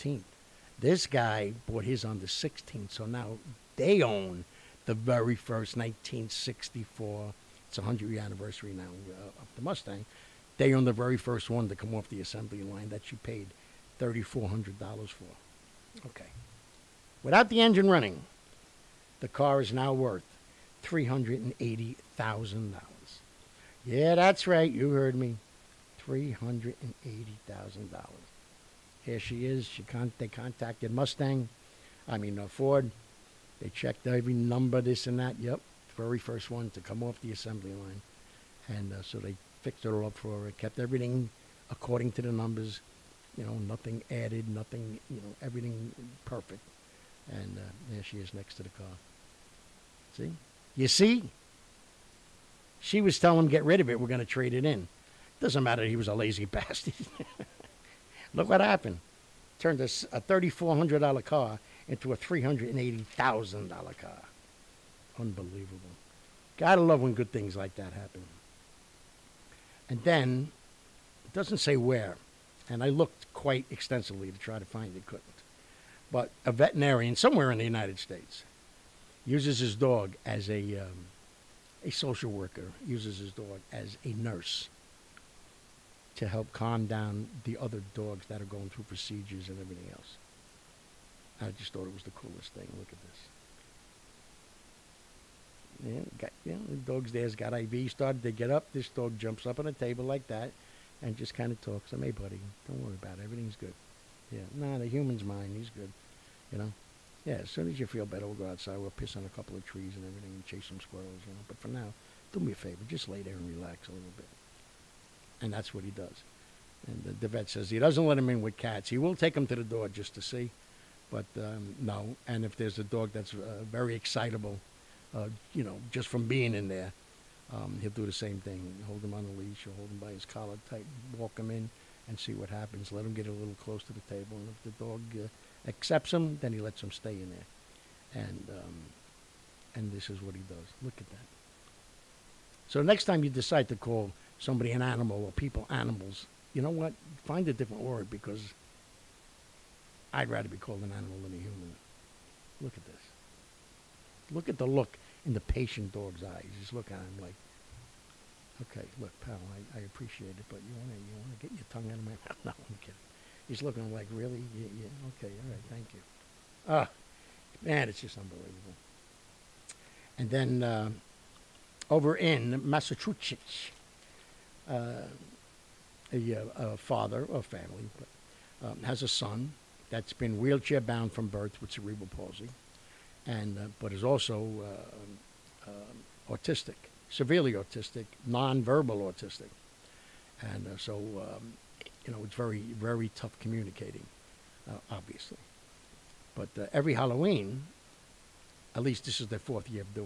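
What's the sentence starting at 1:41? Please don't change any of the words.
I'm, hey, buddy, don't worry about it.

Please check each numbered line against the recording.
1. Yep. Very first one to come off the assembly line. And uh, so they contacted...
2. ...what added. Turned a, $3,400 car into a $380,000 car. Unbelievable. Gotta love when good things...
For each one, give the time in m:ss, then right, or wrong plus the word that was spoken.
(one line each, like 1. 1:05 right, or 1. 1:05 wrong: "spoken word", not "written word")
1. 0:35 wrong: "fixed", not "contacted"
2. 0:58 wrong: "happened", not "added".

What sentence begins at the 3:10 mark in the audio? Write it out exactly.
Um, you know, it's very, very tough communicating, uh, obviously.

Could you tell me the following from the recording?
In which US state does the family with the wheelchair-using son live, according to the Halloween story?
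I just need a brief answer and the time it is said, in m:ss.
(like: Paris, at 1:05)
Massachusetts, at 2:52.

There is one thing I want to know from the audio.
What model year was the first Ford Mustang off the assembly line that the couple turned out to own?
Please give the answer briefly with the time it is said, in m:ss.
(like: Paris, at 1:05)
1964, at 0:05.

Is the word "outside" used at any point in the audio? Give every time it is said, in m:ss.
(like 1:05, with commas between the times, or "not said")
1:48.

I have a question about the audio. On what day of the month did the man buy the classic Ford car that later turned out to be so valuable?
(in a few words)
16th.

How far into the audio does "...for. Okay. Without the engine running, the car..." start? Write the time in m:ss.
0:15.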